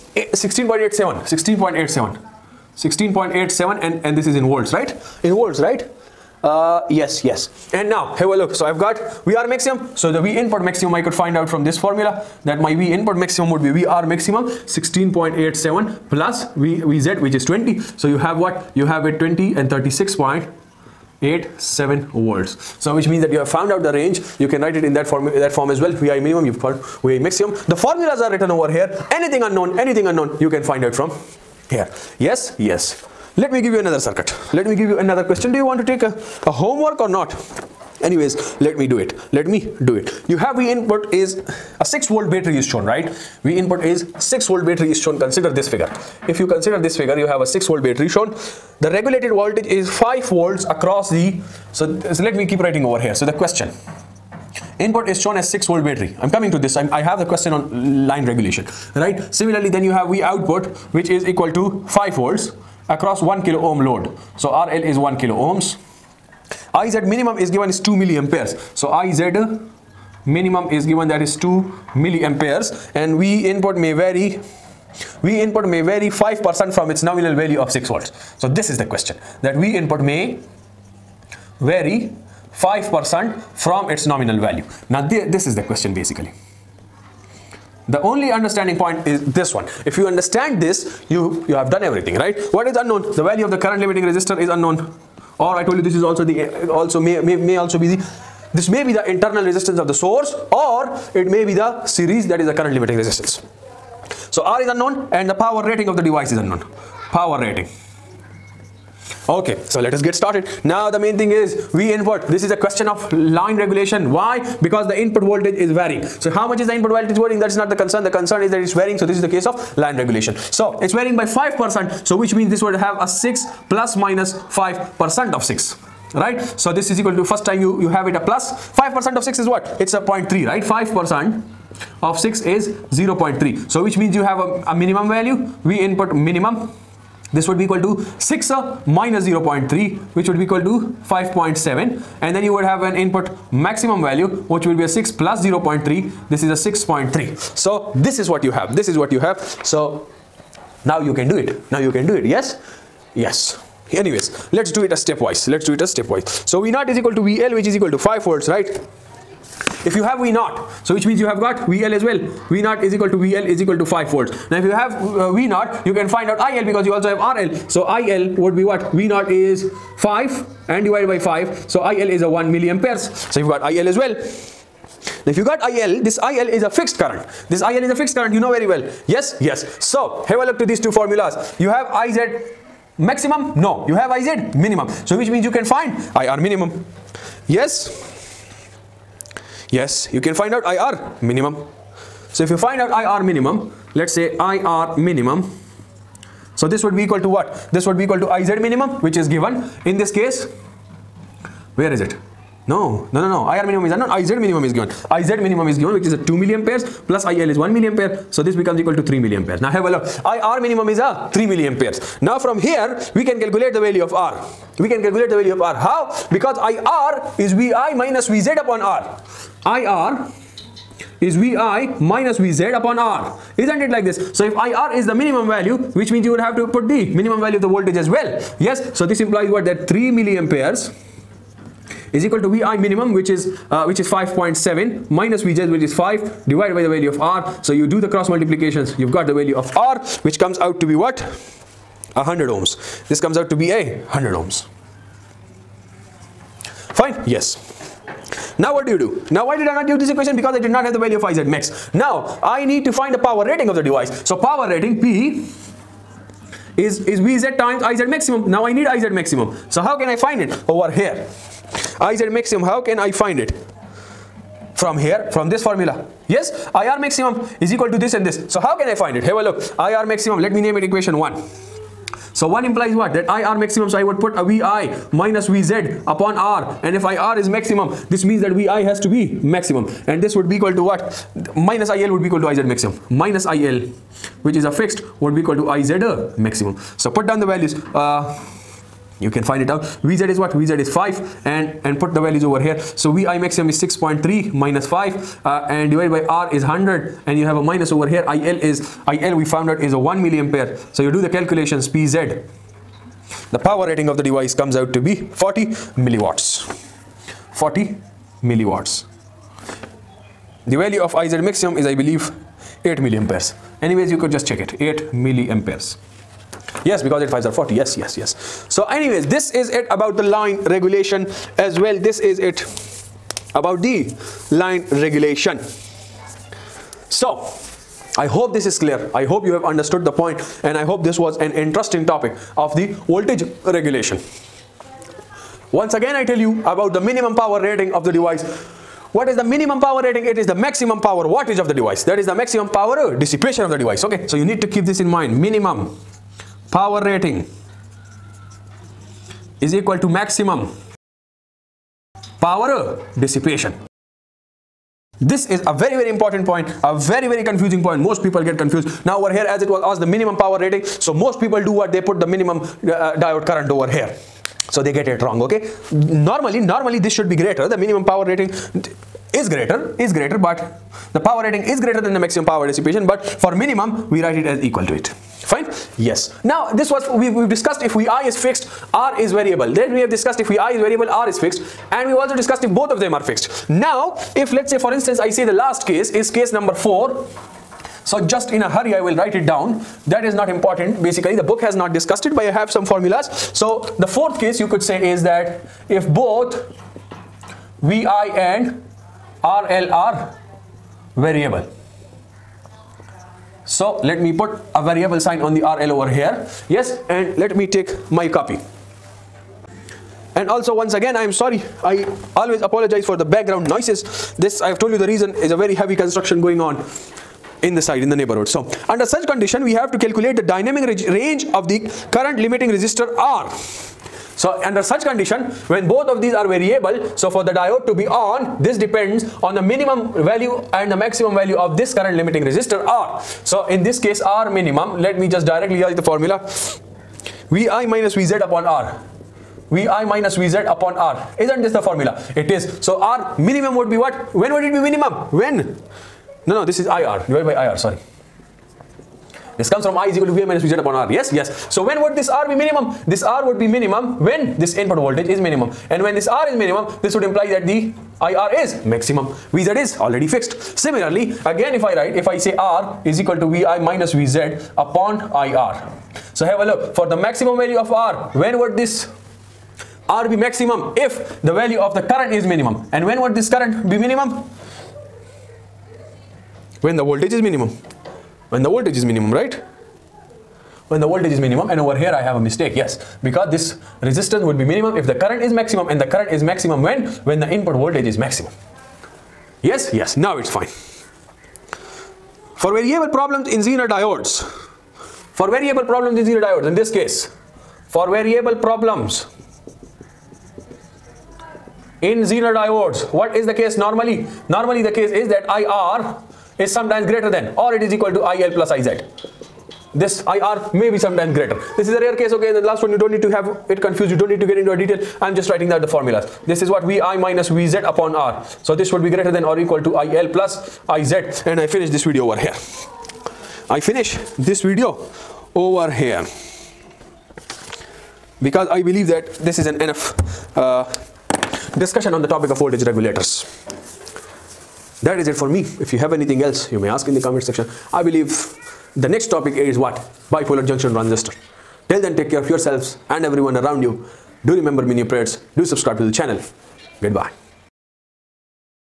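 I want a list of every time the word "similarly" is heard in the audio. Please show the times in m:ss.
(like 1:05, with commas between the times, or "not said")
0:59, 7:40.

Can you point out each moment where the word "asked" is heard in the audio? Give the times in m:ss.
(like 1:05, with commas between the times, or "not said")
5:59.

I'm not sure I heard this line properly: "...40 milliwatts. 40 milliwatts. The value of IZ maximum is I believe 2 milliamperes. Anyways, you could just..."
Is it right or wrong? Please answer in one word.
wrong.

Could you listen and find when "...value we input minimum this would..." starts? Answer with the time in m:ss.
2:15.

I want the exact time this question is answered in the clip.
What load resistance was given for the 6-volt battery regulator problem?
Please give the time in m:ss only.
1:03.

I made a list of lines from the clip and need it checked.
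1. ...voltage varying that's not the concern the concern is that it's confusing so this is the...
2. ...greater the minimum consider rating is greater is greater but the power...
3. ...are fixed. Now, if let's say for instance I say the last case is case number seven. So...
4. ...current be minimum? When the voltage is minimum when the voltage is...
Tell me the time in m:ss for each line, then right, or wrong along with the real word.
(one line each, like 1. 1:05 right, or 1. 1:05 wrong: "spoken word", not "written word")
1. 1:56 wrong: "varying", not "confusing"
2. 6:07 wrong: "power", not "consider"
3. 6:23 wrong: "four", not "seven"
4. 7:53 right.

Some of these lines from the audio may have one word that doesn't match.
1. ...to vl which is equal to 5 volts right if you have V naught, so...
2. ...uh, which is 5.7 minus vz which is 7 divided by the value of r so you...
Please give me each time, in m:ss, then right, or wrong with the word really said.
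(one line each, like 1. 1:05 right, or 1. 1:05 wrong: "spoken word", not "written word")
1. 2:37 right
2. 3:53 wrong: "5", not "7".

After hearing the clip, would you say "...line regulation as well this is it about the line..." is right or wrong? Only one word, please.
right.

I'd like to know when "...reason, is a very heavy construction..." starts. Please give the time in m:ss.
6:55.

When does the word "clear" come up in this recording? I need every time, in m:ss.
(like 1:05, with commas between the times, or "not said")
5:28.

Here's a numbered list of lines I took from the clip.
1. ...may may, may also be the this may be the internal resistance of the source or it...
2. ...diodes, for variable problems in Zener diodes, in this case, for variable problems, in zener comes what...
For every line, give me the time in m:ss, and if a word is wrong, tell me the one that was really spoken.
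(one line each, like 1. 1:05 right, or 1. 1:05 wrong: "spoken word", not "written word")
1. 1:36 right
2. 8:13 wrong: "diodes", not "comes".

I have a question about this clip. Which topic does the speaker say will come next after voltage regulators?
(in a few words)
Bipolar junction transistor.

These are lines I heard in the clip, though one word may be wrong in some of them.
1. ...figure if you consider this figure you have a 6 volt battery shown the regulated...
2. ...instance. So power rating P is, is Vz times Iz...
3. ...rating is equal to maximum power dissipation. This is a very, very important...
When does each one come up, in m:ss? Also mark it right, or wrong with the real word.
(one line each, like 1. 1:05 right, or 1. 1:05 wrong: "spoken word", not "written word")
1. 0:45 right
2. 4:13 wrong: "device", not "instance"
3. 5:47 right.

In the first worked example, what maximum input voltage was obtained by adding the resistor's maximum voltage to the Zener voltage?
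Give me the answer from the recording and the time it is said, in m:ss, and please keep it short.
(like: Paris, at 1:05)
36.87 volts, at 0:19.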